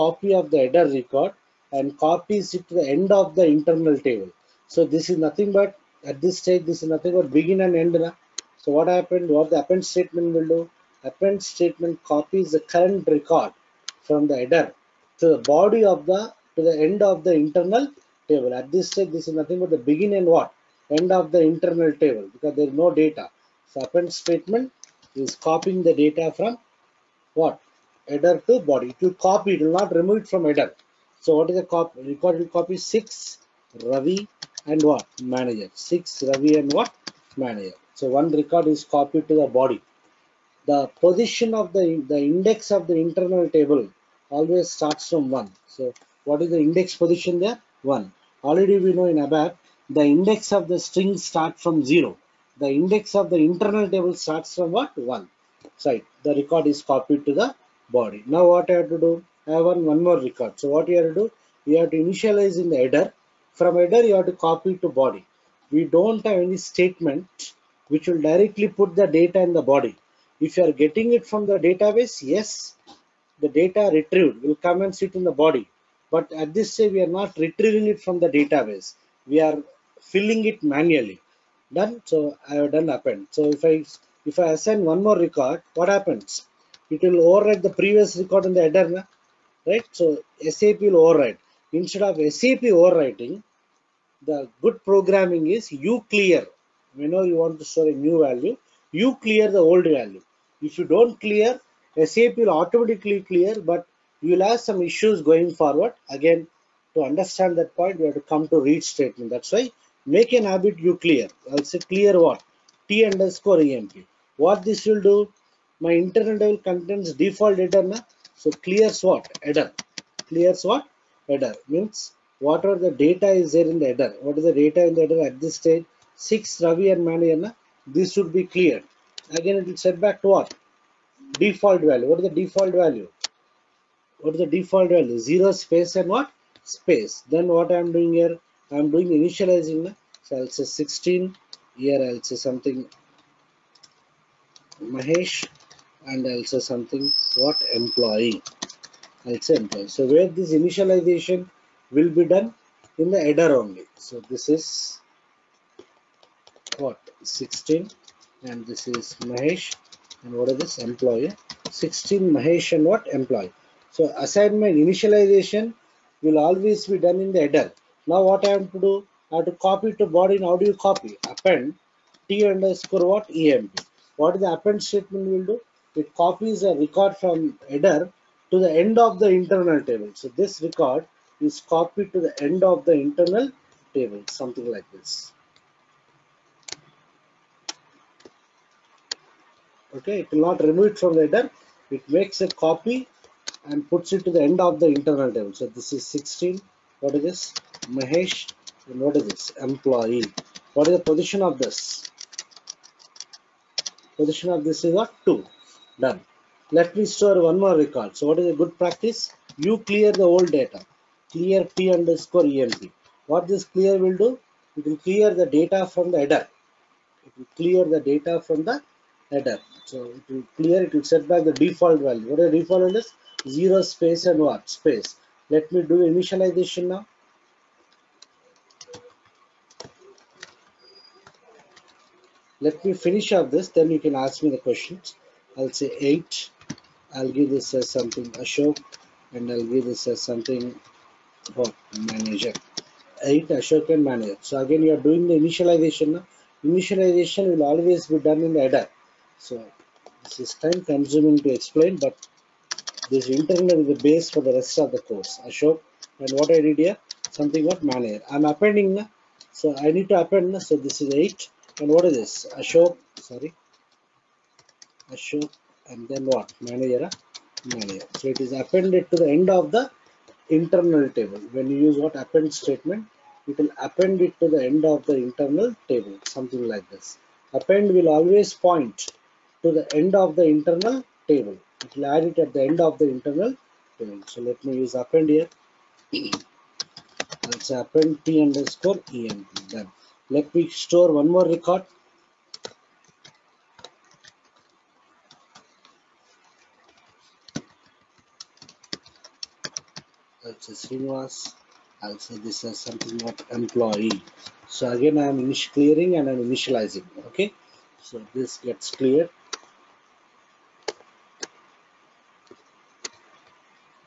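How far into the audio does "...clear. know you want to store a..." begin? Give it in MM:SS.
01:36.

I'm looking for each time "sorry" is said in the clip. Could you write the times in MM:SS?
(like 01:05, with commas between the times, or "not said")
04:23.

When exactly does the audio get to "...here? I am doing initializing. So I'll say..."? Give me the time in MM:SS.
02:18.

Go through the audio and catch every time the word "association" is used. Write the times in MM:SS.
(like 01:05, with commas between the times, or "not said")
not said.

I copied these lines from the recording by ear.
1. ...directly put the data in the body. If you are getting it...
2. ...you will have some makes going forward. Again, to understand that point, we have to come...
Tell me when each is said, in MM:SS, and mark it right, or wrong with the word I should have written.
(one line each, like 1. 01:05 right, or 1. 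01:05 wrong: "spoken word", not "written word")
1. 01:08 right
2. 01:44 wrong: "issues", not "makes".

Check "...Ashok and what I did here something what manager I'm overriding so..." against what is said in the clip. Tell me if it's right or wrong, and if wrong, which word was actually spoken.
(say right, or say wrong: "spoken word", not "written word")
wrong: "appending", not "overriding".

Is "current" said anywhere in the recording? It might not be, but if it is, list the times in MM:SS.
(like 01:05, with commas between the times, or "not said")
00:12.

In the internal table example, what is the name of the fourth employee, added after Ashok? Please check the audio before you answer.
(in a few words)
Srinivas.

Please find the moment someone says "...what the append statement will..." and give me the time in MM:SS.
00:09.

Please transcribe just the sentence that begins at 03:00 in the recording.
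So this record is copied to the end of the internal table, something like this.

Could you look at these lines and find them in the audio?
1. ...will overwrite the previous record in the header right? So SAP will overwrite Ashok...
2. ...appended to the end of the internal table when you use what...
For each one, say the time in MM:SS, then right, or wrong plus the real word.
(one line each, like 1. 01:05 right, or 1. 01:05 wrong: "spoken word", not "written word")
1. 01:27 wrong: "Instead", not "Ashok"
2. 04:28 right.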